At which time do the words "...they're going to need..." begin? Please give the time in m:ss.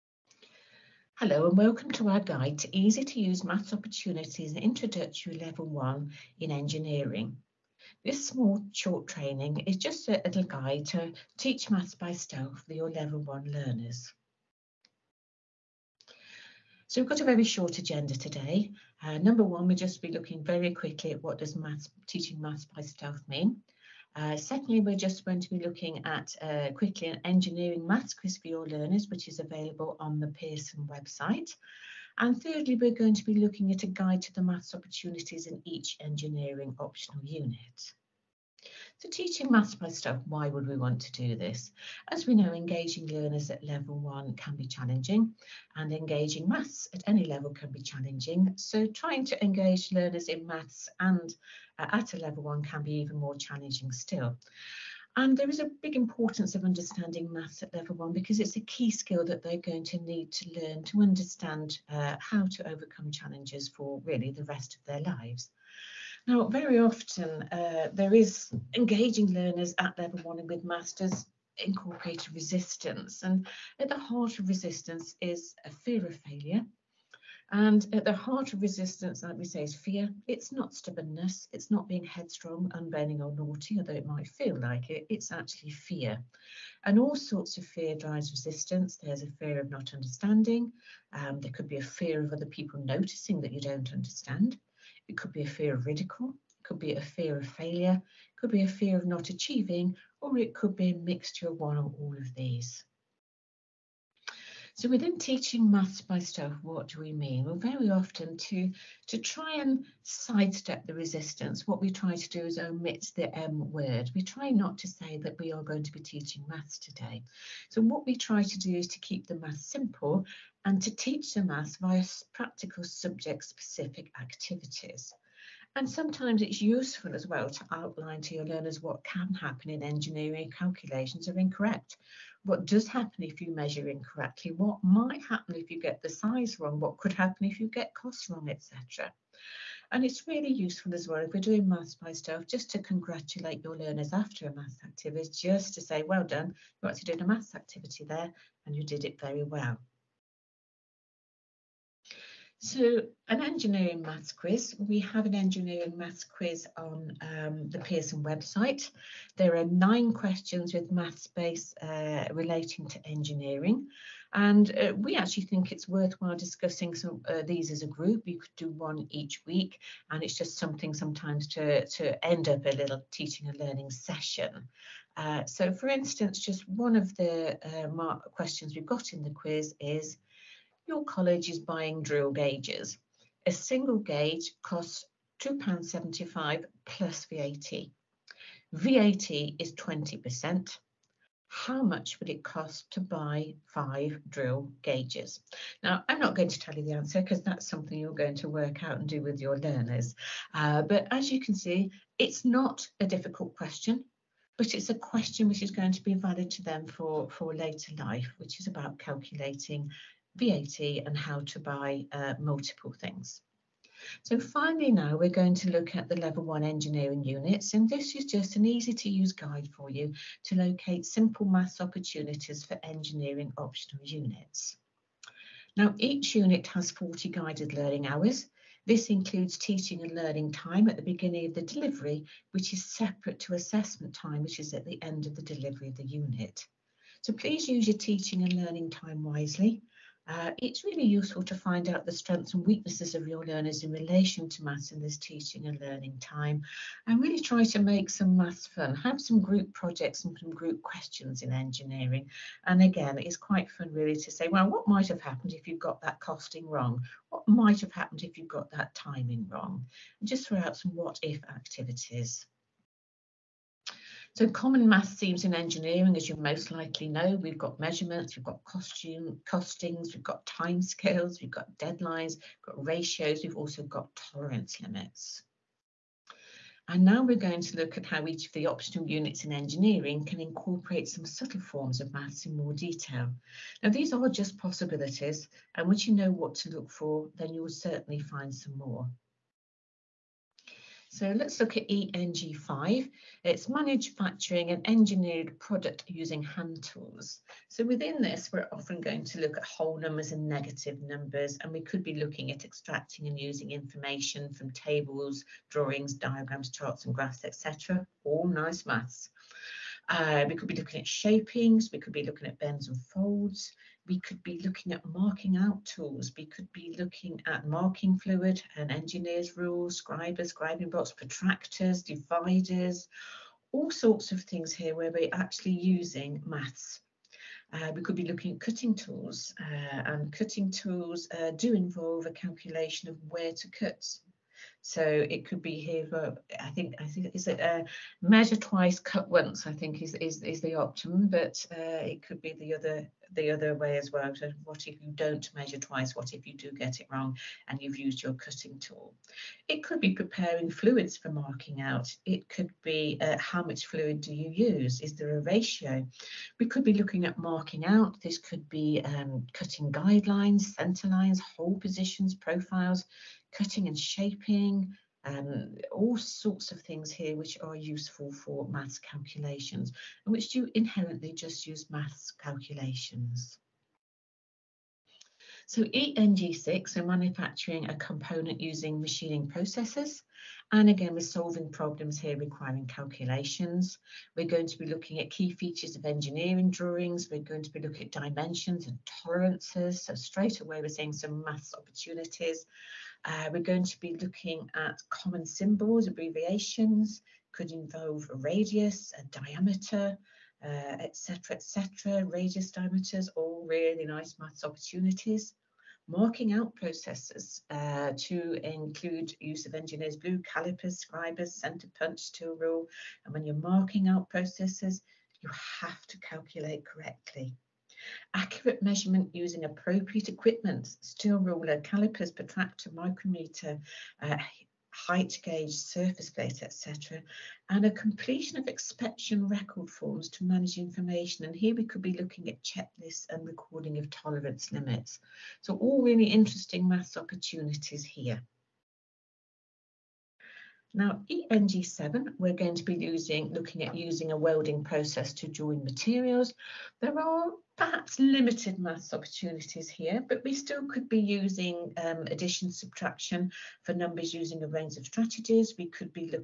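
0:59.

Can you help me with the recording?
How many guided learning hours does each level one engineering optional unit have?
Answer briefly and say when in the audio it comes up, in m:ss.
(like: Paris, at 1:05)
40, at 3:46.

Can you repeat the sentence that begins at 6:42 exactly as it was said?
Et radius diameters, all really nice maths opportunities.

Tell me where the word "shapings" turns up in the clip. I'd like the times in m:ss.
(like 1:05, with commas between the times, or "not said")
5:11, 6:03.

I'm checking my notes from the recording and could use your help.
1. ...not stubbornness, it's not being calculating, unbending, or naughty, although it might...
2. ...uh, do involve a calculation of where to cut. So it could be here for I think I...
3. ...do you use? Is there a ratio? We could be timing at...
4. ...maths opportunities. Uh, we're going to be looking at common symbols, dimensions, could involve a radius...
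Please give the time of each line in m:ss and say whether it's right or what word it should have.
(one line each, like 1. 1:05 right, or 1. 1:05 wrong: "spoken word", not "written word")
1. 1:20 wrong: "headstrong", not "calculating"
2. 5:31 right
3. 5:54 wrong: "looking", not "timing"
4. 6:31 wrong: "abbreviations", not "dimensions".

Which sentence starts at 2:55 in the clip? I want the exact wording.
Uh, so, for instance, just one of the uh, questions we've got in the quiz is your college is buying drill gauges.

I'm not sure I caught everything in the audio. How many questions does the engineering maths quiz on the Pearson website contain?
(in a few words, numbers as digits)
9.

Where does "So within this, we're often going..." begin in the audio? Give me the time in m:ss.
4:57.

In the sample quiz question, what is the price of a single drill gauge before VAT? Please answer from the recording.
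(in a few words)
£2.75.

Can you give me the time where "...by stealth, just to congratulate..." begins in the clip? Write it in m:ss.
2:21.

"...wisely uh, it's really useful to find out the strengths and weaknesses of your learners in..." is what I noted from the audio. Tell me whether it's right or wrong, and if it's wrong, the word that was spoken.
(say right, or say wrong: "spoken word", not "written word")
right.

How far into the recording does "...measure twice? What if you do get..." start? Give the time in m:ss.
5:45.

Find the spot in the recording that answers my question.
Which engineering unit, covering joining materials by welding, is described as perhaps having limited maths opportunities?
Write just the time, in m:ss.
7:21.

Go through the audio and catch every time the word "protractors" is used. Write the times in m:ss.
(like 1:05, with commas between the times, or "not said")
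5:21, 7:02.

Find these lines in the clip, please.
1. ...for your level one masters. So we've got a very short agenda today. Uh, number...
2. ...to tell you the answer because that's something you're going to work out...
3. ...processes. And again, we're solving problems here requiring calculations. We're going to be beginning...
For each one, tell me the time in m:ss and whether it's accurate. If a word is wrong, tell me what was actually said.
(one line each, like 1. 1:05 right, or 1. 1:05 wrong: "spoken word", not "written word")
1. 0:12 wrong: "learners", not "masters"
2. 3:16 right
3. 6:19 wrong: "looking", not "beginning".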